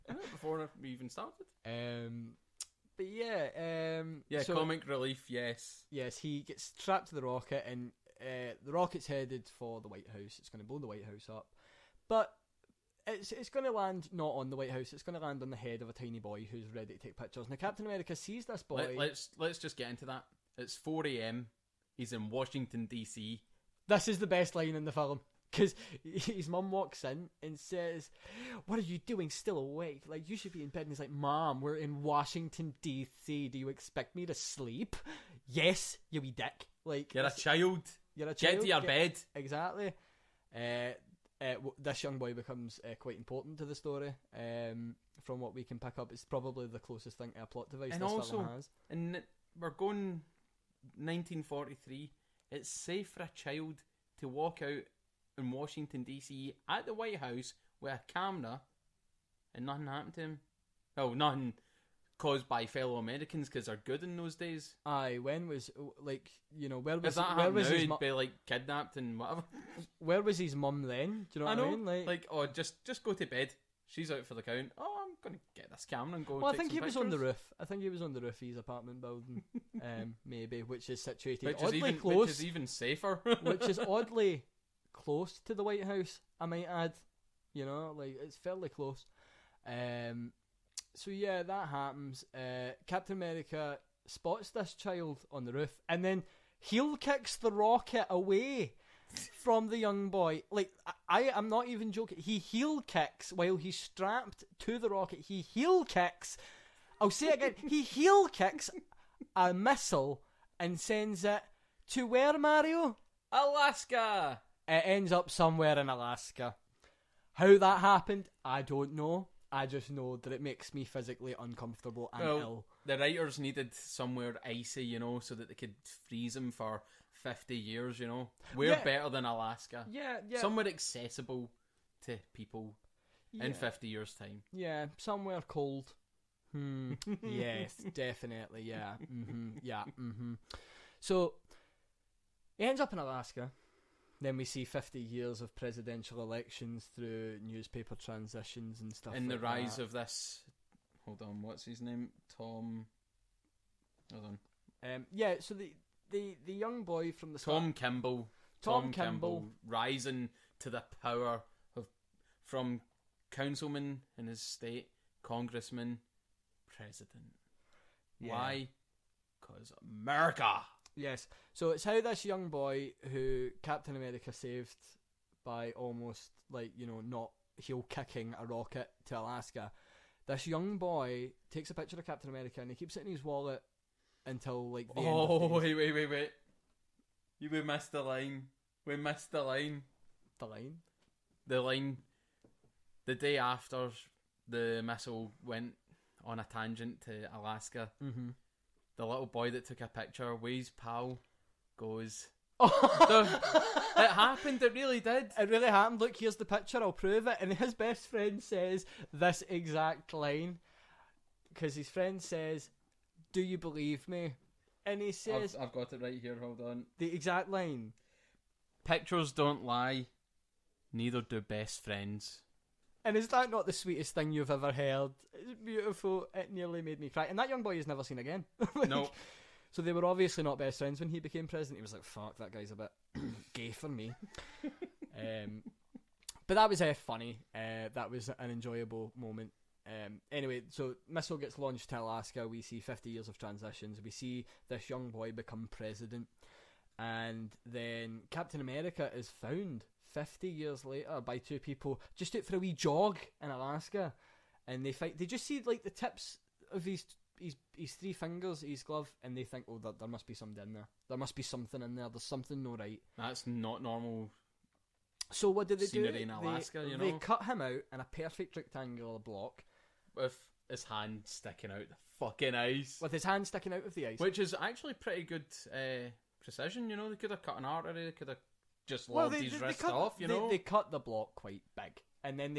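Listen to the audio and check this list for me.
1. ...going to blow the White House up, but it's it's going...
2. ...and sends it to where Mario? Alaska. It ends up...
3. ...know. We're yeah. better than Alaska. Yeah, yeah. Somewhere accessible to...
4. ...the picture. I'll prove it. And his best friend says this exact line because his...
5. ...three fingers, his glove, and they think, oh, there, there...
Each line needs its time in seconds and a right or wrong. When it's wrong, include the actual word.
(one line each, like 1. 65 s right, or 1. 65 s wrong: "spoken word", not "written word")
1. 10 s right
2. 110 s right
3. 128 s right
4. 206 s right
5. 257 s right.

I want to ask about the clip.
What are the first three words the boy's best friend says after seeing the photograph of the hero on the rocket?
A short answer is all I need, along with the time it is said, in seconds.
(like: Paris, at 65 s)
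Pictures don't lie, at 218 s.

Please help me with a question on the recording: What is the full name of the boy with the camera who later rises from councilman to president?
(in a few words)
Tom Kimball.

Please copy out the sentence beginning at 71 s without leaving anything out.
Like, like, oh, just just go to bed.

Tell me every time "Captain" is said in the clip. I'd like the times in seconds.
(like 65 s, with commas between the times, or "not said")
17 s, 92 s, 173 s, 182 s, 248 s.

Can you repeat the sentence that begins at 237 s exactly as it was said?
Uh, that was an enjoyable moment.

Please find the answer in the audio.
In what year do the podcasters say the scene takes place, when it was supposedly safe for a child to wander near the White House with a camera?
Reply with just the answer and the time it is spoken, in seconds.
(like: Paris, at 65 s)
1943, at 50 s.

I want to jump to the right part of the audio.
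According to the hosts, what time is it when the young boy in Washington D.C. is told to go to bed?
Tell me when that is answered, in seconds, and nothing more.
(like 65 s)
20 s.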